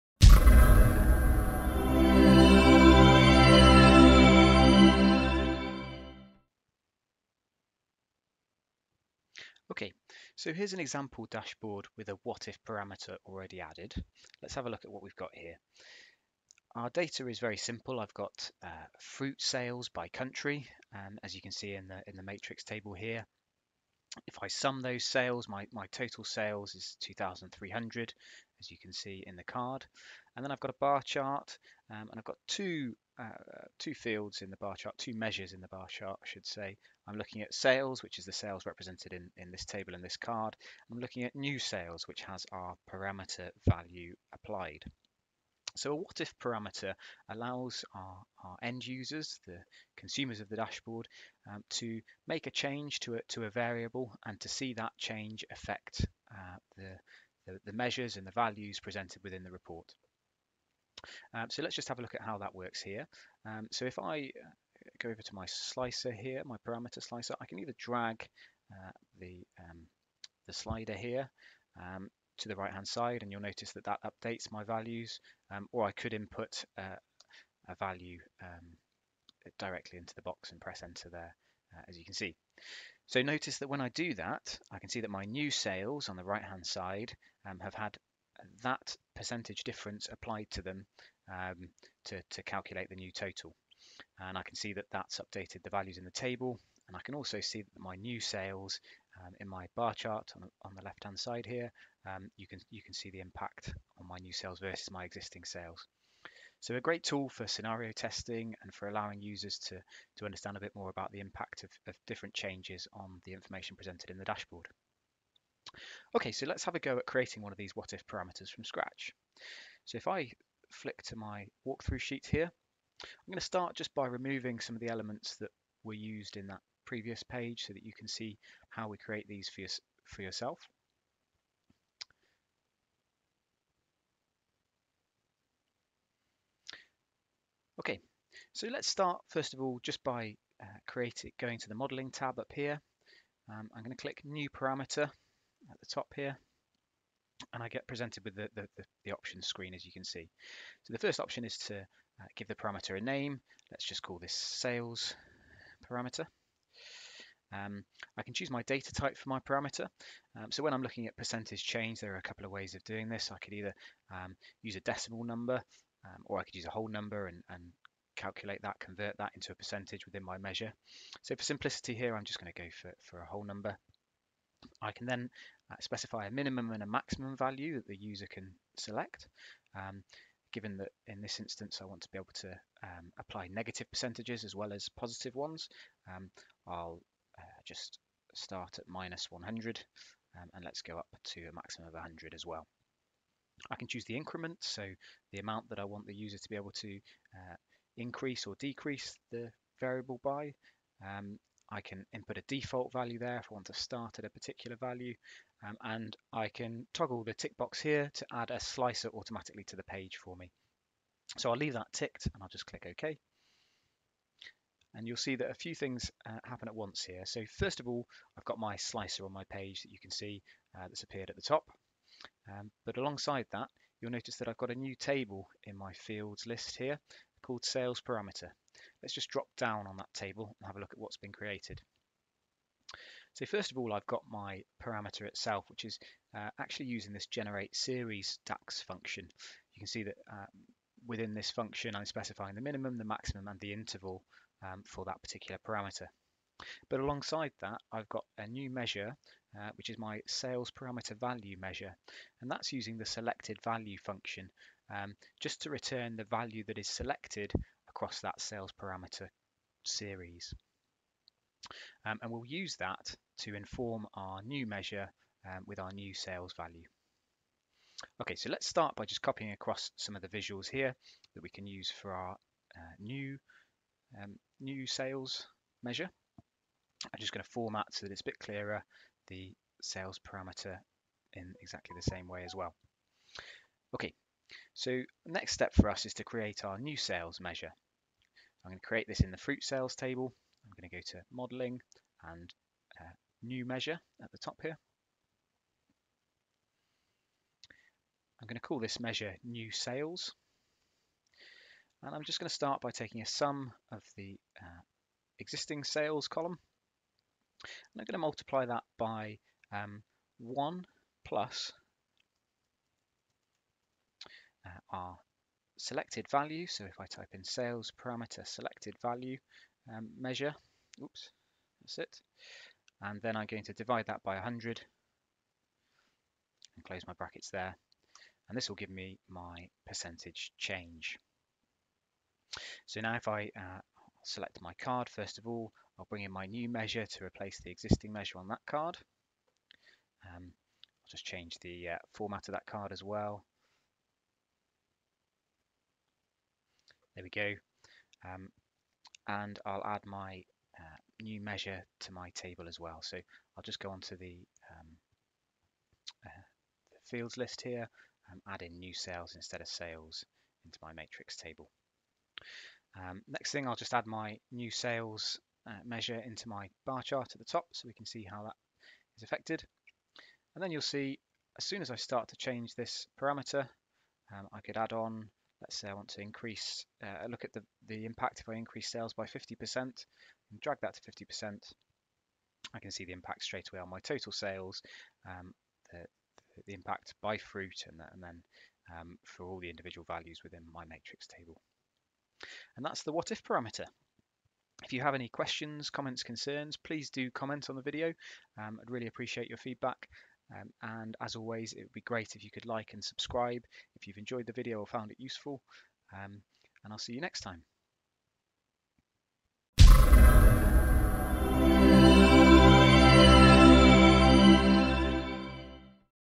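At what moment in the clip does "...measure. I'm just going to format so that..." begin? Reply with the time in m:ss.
4:35.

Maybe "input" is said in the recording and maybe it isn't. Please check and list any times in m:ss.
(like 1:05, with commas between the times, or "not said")
1:16, 3:22.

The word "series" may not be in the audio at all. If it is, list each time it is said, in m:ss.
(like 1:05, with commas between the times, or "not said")
3:57, 4:19.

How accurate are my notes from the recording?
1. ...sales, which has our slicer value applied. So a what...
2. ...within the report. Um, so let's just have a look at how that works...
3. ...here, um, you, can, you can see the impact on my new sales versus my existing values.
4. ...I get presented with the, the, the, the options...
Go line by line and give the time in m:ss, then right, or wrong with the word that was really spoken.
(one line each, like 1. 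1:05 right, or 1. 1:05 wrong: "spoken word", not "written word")
1. 0:41 wrong: "parameter", not "slicer"
2. 0:59 right
3. 1:41 wrong: "sales", not "values"
4. 2:27 right.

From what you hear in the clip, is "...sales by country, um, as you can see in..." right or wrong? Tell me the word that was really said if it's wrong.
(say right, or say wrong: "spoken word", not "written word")
right.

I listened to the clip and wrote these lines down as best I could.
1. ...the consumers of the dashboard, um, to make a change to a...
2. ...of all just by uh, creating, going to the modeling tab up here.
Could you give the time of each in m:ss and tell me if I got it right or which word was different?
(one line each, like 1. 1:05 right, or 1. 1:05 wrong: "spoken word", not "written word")
1. 0:49 right
2. 2:19 right.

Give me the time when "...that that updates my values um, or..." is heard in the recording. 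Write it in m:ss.
1:13.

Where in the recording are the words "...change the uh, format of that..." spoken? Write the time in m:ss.
5:41.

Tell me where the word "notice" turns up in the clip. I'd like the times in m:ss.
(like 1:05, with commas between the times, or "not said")
1:13, 1:23, 3:44.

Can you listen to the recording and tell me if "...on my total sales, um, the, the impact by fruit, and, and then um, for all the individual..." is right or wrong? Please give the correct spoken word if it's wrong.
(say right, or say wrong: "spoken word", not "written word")
right.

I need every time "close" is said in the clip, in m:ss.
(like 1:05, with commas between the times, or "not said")
5:26.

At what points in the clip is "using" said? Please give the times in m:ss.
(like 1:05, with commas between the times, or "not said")
3:56, 4:12.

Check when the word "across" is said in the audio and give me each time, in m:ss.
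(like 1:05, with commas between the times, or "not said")
4:17, 4:29.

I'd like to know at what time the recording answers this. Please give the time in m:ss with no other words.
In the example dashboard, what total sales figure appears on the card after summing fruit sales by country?
0:26.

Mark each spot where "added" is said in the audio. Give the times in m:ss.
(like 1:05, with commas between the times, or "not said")
0:13.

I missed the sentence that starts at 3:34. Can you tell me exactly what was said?
And you'll see that a few things uh, happen at once here.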